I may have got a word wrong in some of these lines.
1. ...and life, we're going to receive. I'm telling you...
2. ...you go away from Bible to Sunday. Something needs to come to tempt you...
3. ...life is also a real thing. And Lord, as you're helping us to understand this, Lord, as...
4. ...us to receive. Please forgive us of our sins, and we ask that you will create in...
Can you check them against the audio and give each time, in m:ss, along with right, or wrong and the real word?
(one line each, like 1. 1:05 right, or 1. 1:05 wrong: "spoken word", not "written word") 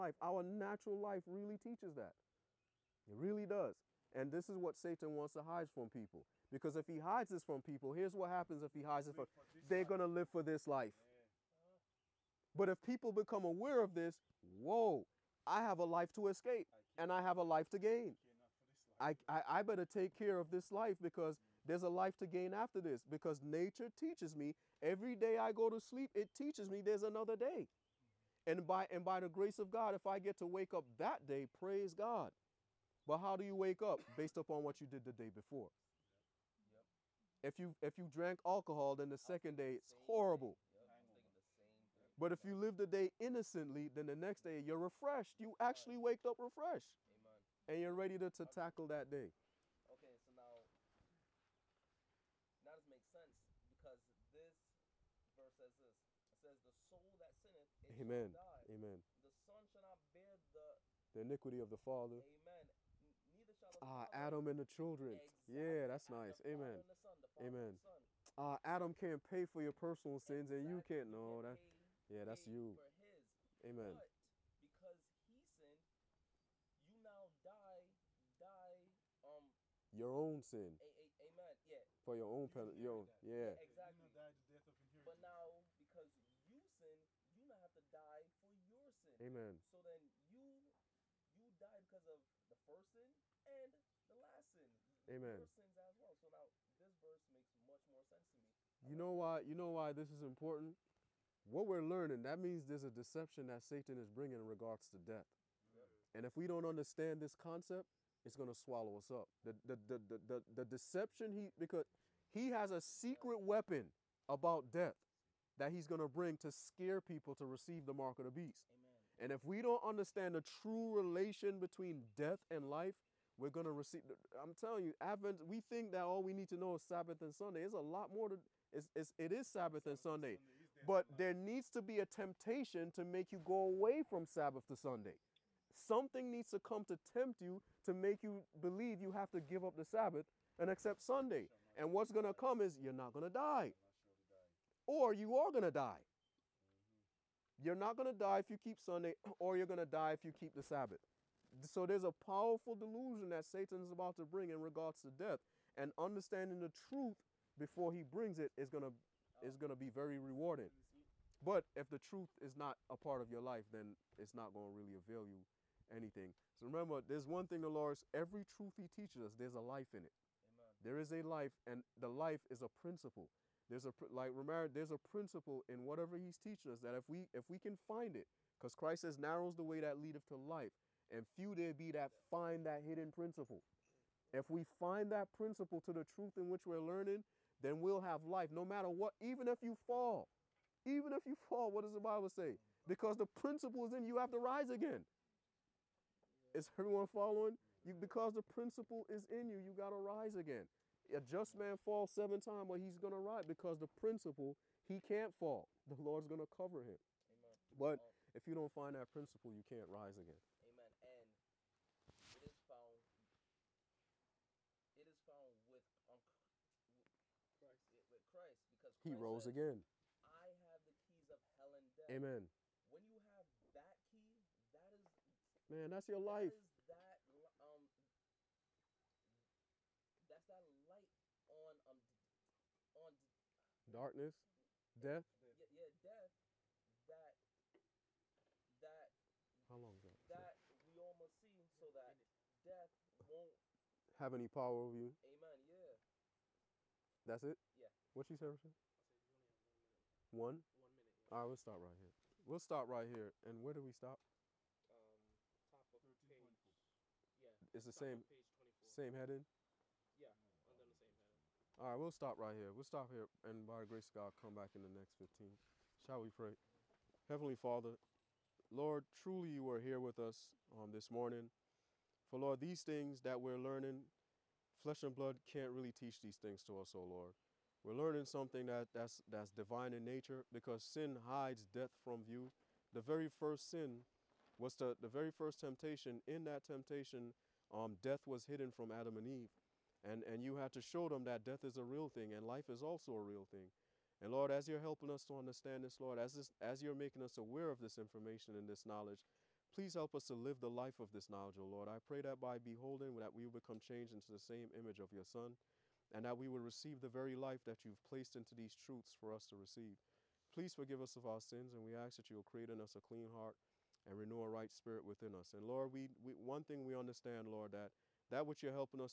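1. 2:02 right
2. 2:13 wrong: "Sabbath", not "Bible"
3. 4:52 right
4. 5:09 right.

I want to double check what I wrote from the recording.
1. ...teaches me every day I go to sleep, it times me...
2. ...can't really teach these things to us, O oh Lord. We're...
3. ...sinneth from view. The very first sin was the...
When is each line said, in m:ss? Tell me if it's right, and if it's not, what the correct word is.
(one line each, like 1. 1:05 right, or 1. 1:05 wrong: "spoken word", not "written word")
1. 0:23 wrong: "teaches", not "times"
2. 4:35 right
3. 4:41 wrong: "death", not "sinneth".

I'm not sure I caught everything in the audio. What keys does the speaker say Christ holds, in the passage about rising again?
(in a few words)
hell and death.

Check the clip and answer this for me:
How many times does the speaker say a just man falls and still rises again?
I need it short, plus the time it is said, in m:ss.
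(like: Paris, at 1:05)
7, at 3:22.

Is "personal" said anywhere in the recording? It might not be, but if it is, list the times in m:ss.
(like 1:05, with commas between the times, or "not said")
1:09.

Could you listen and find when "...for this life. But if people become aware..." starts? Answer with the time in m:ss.
0:10.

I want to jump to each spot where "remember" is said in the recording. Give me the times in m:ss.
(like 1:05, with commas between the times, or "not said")
2:46, 2:54.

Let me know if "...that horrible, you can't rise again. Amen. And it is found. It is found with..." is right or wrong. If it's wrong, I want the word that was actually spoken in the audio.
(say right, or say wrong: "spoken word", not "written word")
wrong: "principle", not "horrible".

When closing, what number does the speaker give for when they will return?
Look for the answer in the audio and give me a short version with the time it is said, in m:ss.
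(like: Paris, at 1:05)
15, at 4:25.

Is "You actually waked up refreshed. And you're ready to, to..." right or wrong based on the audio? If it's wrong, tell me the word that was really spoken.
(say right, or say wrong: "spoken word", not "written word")
right.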